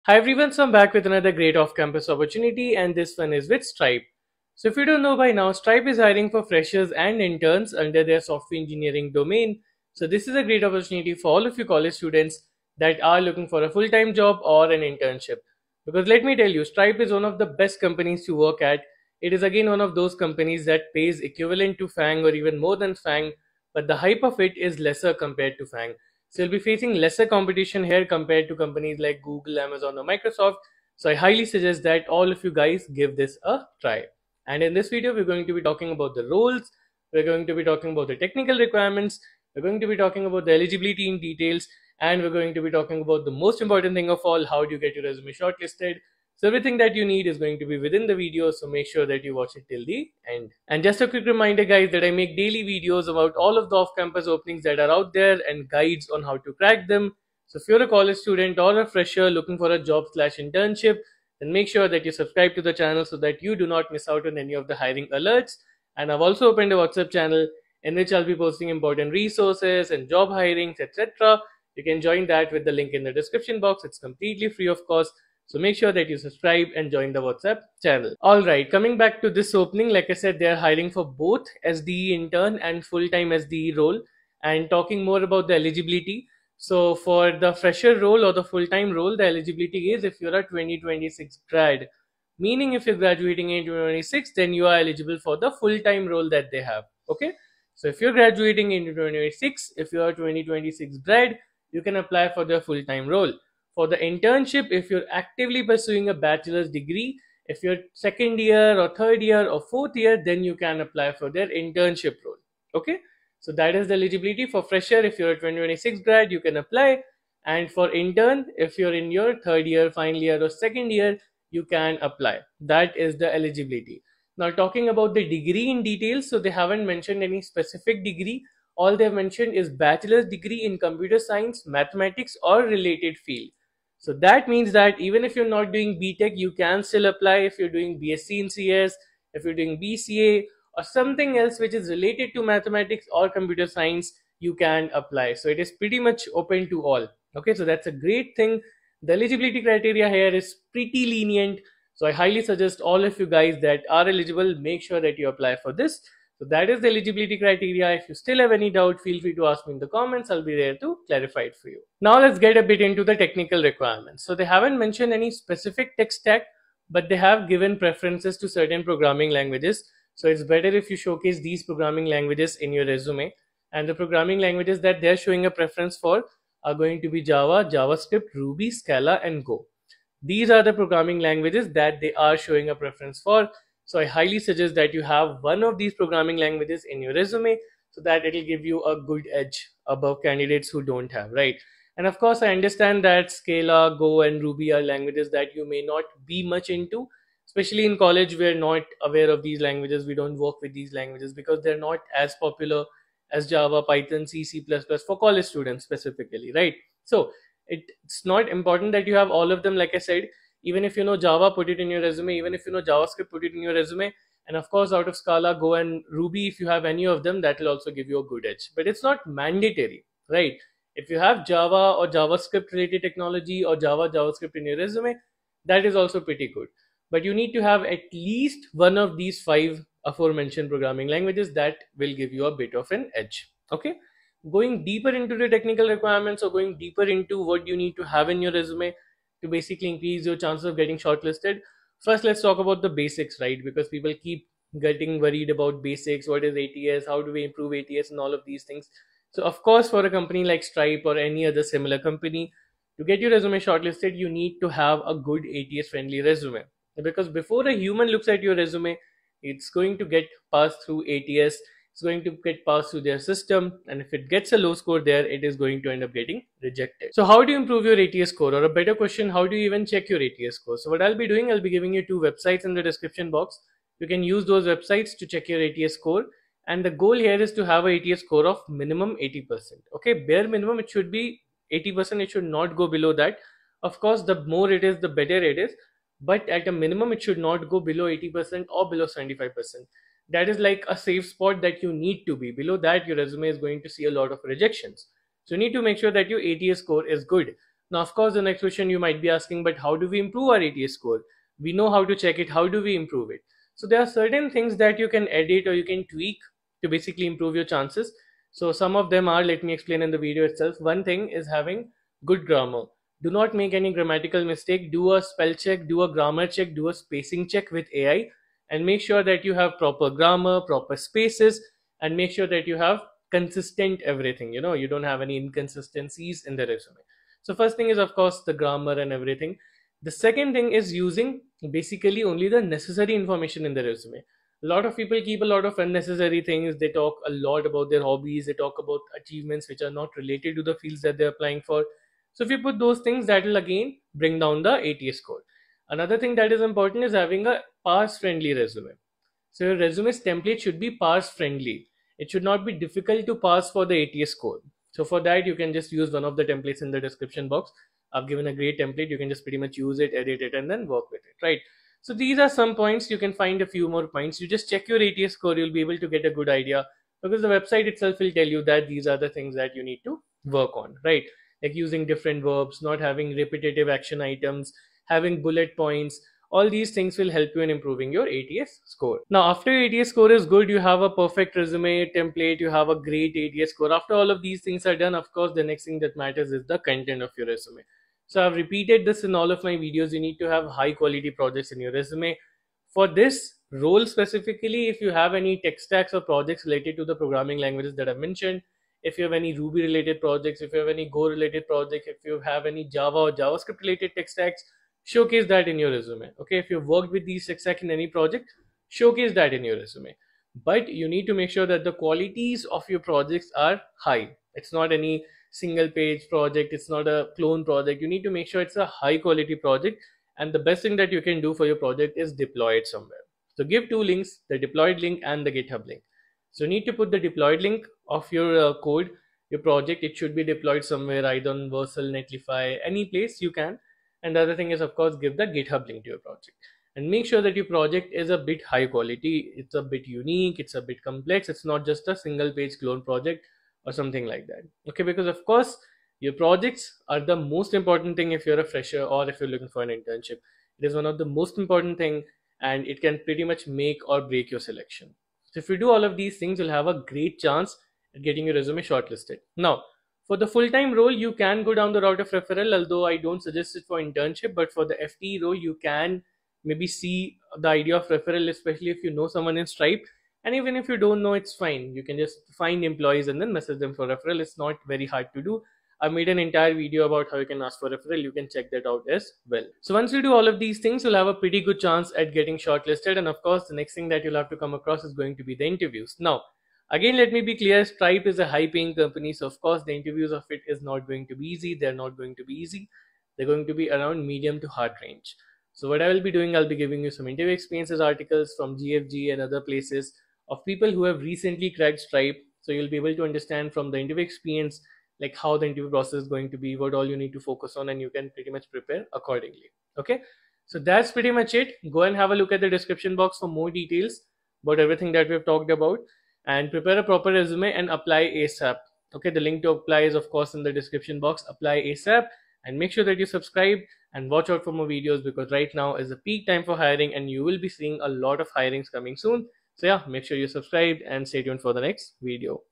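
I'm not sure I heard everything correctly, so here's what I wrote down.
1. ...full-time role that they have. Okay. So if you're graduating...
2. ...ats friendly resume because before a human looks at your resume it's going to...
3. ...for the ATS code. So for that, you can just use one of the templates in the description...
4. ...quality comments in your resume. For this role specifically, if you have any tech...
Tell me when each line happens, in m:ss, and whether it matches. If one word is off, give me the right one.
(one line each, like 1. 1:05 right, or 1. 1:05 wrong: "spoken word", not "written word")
1. 1:35 right
2. 4:15 right
3. 5:53 right
4. 6:30 wrong: "projects", not "comments".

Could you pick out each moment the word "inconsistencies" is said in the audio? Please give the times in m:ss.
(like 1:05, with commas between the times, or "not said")
5:25.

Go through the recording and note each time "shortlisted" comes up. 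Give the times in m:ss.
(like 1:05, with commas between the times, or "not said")
0:45, 4:00, 4:13, 7:38, 8:02.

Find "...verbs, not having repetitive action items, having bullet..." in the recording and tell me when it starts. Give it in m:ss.
6:12.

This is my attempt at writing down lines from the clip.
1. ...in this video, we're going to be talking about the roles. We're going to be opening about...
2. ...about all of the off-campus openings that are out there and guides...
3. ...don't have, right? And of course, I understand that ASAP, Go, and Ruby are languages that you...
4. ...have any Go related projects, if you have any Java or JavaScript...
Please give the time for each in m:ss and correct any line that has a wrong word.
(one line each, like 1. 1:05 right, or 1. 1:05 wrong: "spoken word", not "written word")
1. 0:34 wrong: "talking", not "opening"
2. 0:53 right
3. 3:10 wrong: "Scala", not "ASAP"
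4. 6:40 right.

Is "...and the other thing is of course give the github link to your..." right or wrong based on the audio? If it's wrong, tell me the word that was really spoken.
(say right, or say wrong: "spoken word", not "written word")
right.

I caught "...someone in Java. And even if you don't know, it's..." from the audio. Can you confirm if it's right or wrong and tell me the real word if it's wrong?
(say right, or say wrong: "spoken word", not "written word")
wrong: "Stripe", not "Java".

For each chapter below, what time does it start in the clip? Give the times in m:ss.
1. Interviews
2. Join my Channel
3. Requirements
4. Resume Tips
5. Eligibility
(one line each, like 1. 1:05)
1. 8:01
2. 0:50
3. 2:42
4. 3:56
5. 1:18.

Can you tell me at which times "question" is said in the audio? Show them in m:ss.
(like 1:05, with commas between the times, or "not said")
4:29, 4:58.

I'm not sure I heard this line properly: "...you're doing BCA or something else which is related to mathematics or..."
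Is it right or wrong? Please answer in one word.
right.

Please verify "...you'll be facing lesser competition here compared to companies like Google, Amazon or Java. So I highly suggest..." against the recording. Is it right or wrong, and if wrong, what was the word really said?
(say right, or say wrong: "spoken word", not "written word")
wrong: "Microsoft", not "Java".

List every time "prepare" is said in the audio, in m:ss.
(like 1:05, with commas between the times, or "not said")
8:28, 8:36.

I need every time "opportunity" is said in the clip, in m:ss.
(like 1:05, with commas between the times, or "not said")
0:02, 0:10.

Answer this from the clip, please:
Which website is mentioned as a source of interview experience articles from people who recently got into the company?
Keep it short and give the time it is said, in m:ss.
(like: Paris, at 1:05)
GFG, at 8:18.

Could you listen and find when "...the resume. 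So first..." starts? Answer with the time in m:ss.
5:26.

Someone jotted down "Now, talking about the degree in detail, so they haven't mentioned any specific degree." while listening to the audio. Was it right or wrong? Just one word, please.
right.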